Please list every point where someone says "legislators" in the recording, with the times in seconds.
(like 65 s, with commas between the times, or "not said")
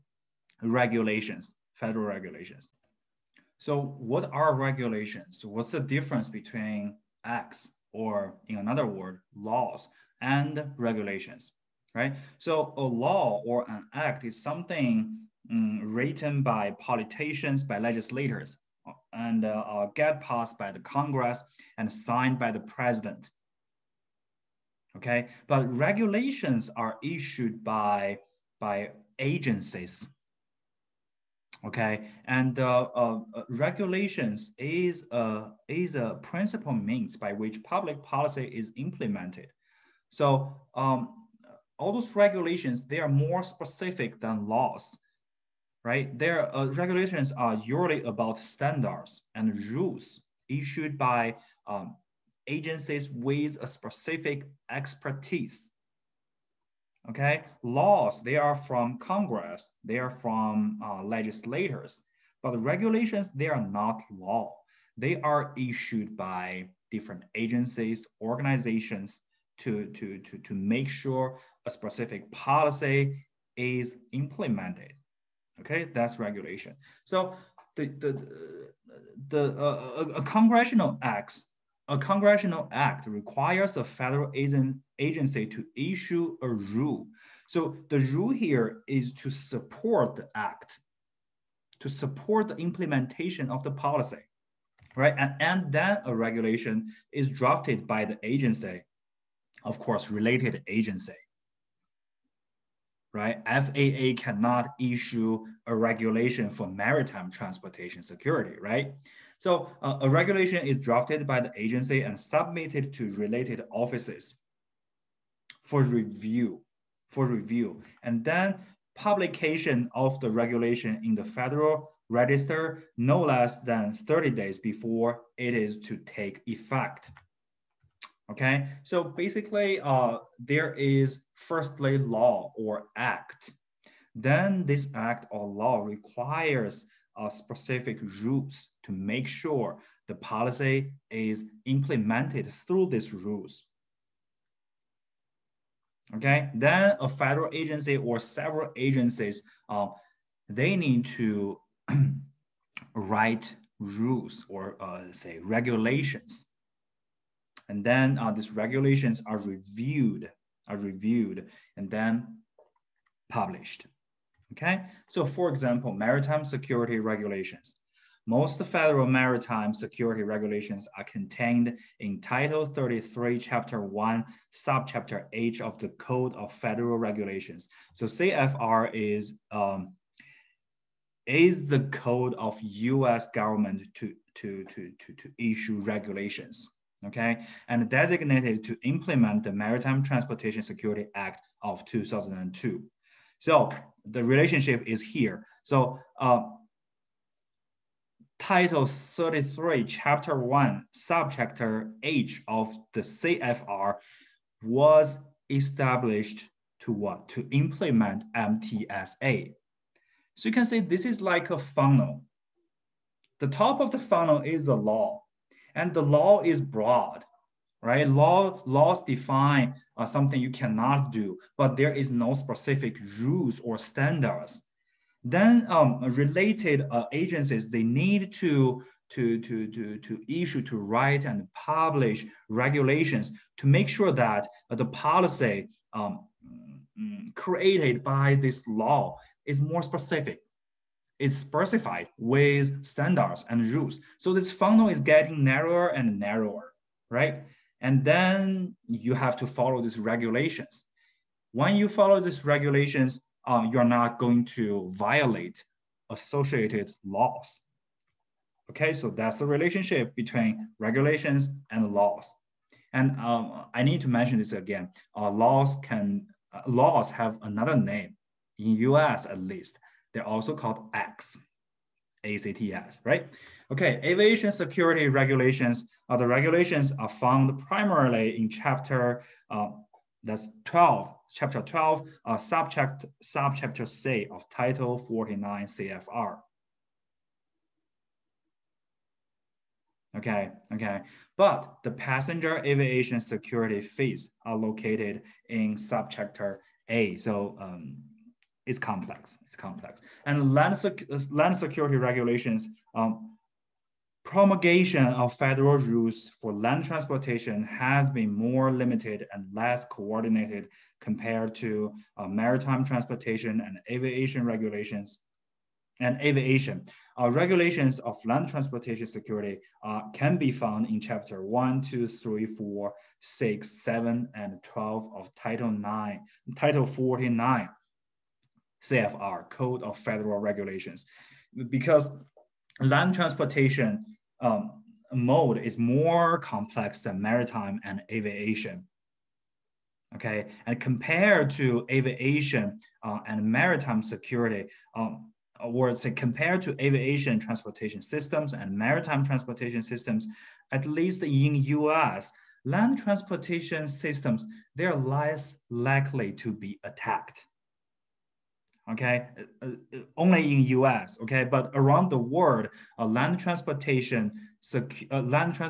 17 s, 61 s.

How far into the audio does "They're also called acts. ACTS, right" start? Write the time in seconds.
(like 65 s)
270 s.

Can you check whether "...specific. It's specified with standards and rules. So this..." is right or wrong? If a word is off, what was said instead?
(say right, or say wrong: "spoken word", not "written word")
right.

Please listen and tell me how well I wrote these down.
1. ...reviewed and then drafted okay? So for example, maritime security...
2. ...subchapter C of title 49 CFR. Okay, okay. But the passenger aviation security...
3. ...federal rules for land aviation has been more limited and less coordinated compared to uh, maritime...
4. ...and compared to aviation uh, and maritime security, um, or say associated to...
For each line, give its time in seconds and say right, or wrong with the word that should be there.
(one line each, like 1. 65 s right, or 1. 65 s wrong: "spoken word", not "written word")
1. 160 s wrong: "published", not "drafted"
2. 283 s right
3. 305 s wrong: "transportation", not "aviation"
4. 340 s wrong: "compared", not "associated".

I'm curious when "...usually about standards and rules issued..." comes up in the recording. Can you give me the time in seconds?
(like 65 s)
47 s.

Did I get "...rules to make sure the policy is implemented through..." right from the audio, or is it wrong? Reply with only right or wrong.
right.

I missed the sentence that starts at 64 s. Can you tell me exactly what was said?
They are issued by different agencies, organizations to, to, to, to make sure a specific policy is implemented.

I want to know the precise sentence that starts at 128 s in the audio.
Okay, so basically uh, there is firstly law or act.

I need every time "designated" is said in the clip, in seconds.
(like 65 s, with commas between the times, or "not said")
187 s.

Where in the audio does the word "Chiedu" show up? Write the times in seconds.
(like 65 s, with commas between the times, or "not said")
not said.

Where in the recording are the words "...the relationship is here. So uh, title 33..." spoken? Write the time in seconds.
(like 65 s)
194 s.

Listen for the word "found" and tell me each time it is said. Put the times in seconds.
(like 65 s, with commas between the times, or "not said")
277 s, 320 s.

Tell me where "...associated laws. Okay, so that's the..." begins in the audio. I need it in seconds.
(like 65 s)
256 s.